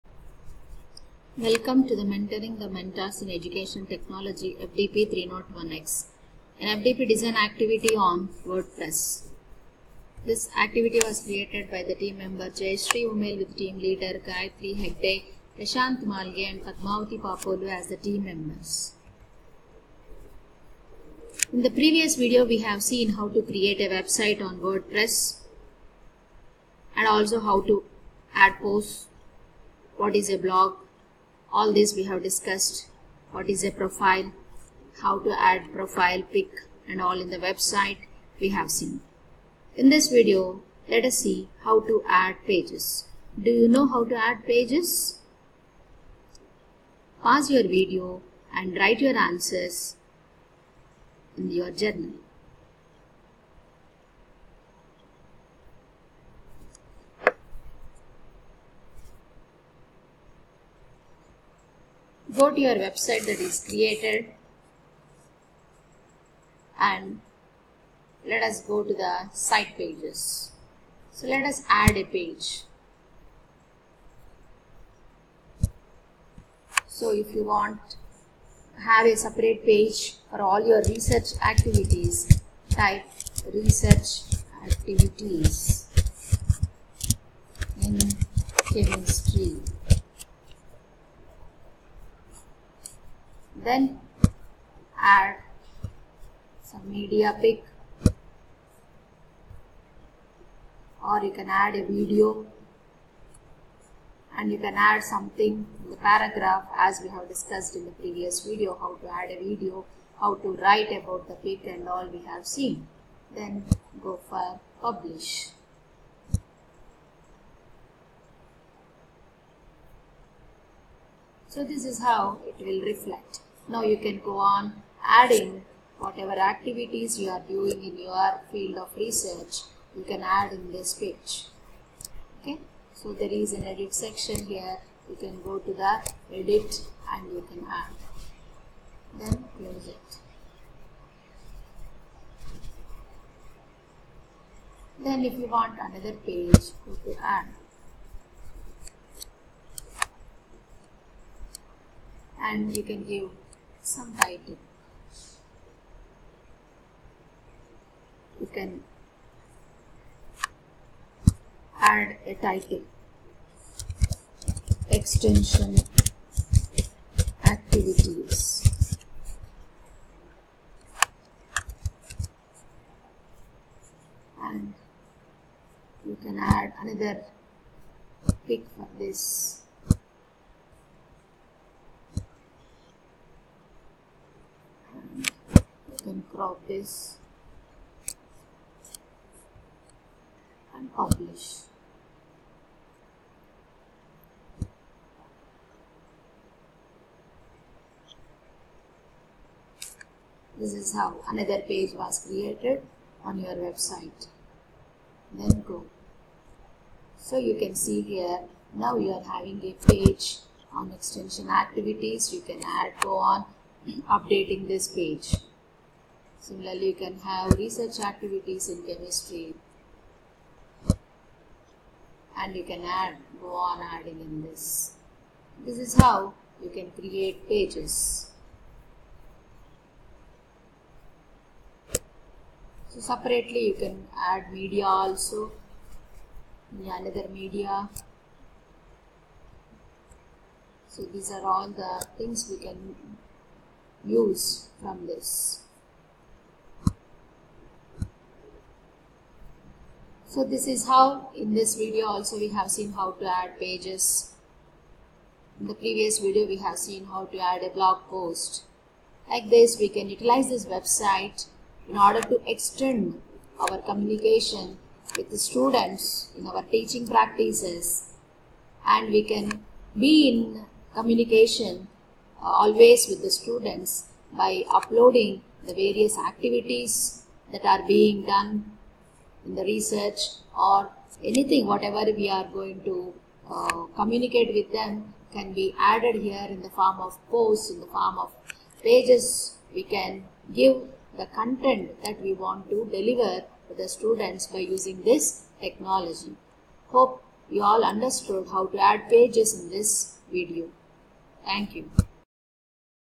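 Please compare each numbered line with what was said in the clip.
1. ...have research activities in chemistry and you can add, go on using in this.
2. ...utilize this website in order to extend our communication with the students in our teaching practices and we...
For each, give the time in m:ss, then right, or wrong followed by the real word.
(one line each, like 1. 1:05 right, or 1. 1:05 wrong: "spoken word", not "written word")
1. 3:37 wrong: "adding", not "using"
2. 4:20 right.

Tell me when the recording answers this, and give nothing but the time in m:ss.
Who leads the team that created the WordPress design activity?
0:14.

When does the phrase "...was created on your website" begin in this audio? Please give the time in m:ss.
3:21.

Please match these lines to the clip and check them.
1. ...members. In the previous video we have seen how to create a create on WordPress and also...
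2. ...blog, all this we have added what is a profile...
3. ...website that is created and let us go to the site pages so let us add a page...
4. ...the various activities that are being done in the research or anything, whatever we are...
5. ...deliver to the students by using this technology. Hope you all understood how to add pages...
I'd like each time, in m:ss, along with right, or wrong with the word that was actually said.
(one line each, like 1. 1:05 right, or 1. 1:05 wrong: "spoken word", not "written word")
1. 0:18 wrong: "website", not "create"
2. 0:30 wrong: "discussed", not "added"
3. 1:02 right
4. 4:35 right
5. 4:52 right.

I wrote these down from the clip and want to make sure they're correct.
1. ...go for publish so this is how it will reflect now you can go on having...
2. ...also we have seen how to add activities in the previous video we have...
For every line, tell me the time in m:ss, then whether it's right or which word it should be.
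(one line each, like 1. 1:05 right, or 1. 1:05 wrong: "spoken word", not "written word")
1. 1:54 wrong: "adding", not "having"
2. 4:12 wrong: "pages", not "activities".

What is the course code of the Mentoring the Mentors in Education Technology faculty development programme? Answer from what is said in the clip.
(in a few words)
FDP 301X.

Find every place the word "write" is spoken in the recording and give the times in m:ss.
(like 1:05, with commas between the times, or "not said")
0:48, 1:50.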